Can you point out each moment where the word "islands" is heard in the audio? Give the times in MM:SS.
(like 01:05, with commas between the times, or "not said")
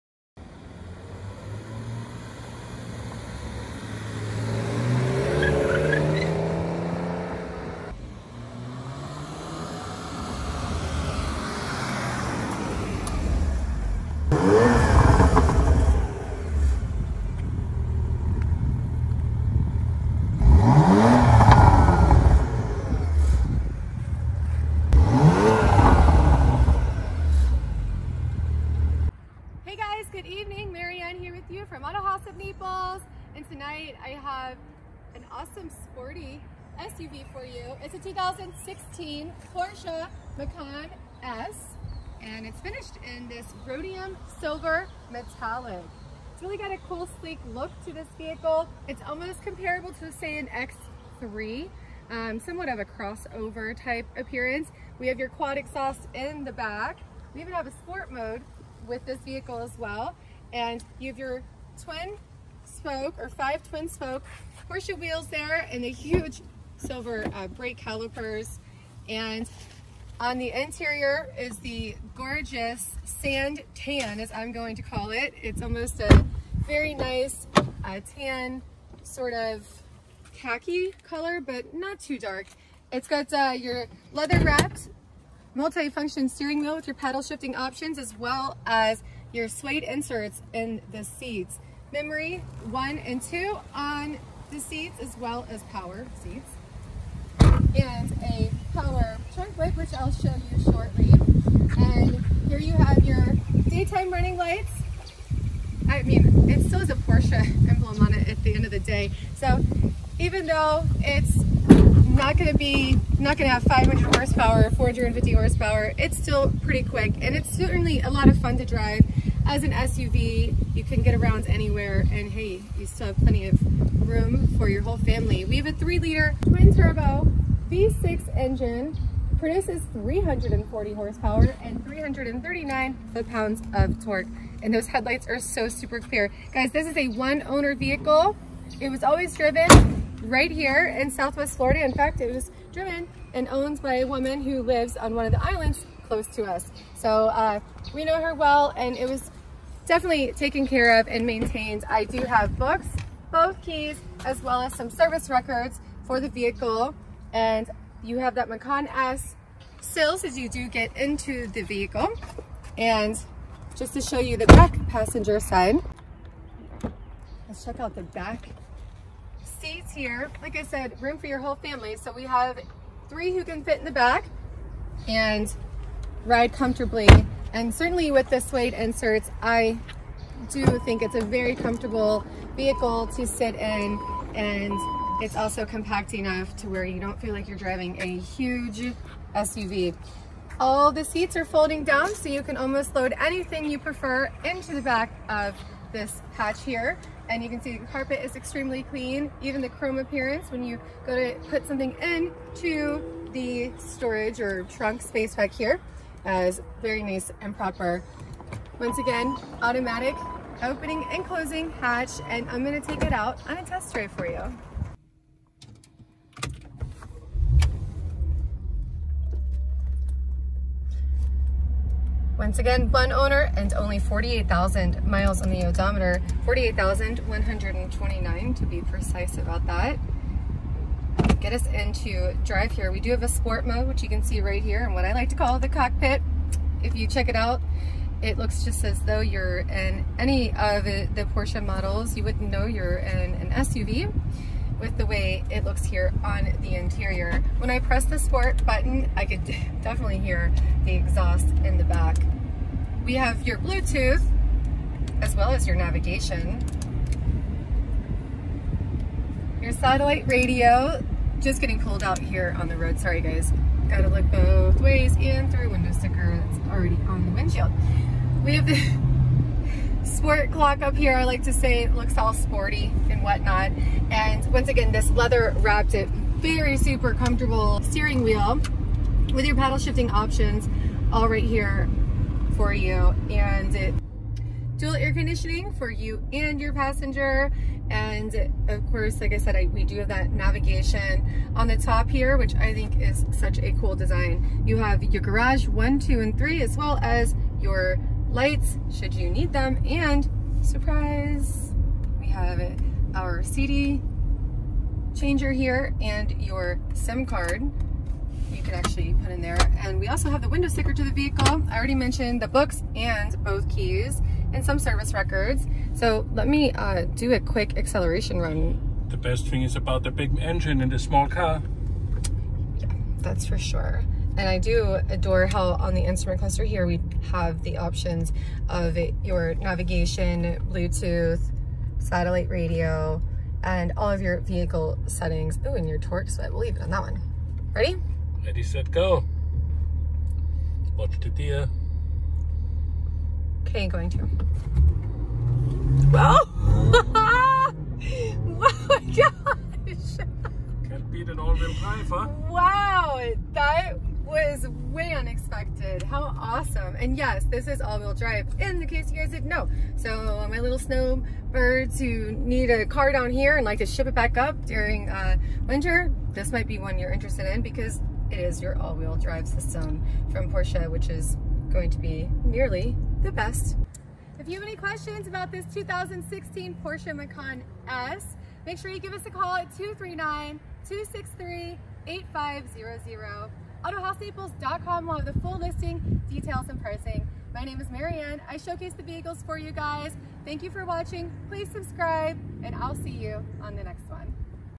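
02:25.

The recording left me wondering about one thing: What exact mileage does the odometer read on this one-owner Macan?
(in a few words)
48,129.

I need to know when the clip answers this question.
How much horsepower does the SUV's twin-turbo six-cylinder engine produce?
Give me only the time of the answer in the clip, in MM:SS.
02:09.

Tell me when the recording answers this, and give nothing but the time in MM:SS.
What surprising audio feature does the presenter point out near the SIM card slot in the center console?
05:03.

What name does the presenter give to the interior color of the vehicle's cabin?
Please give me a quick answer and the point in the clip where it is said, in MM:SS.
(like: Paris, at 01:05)
Sand tan, at 01:13.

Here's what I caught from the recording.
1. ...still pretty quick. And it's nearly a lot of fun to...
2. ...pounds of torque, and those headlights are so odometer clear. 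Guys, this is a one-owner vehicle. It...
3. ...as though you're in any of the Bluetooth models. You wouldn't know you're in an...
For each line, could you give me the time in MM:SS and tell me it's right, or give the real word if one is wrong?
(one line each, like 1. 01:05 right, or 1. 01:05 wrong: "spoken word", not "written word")
1. 01:56 wrong: "certainly", not "nearly"
2. 02:13 wrong: "super", not "odometer"
3. 03:58 wrong: "Porsche", not "Bluetooth".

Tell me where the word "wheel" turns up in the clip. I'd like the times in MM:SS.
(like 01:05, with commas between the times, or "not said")
01:04, 01:26, 04:38, 05:51, 05:57, 06:08.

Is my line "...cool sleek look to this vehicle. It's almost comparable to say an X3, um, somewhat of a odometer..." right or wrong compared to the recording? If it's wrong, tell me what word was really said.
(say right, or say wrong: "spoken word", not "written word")
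wrong: "crossover", not "odometer".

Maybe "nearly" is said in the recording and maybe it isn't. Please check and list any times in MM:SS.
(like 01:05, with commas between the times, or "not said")
06:12.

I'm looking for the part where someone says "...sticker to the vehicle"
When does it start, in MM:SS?
05:10.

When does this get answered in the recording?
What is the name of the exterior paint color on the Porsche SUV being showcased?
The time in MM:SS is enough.
00:43.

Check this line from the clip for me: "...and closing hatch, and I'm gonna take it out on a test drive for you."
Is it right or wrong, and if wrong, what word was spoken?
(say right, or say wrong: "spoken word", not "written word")
right.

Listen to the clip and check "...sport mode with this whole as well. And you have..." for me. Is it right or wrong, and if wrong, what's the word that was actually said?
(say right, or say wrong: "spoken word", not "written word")
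wrong: "vehicle", not "whole".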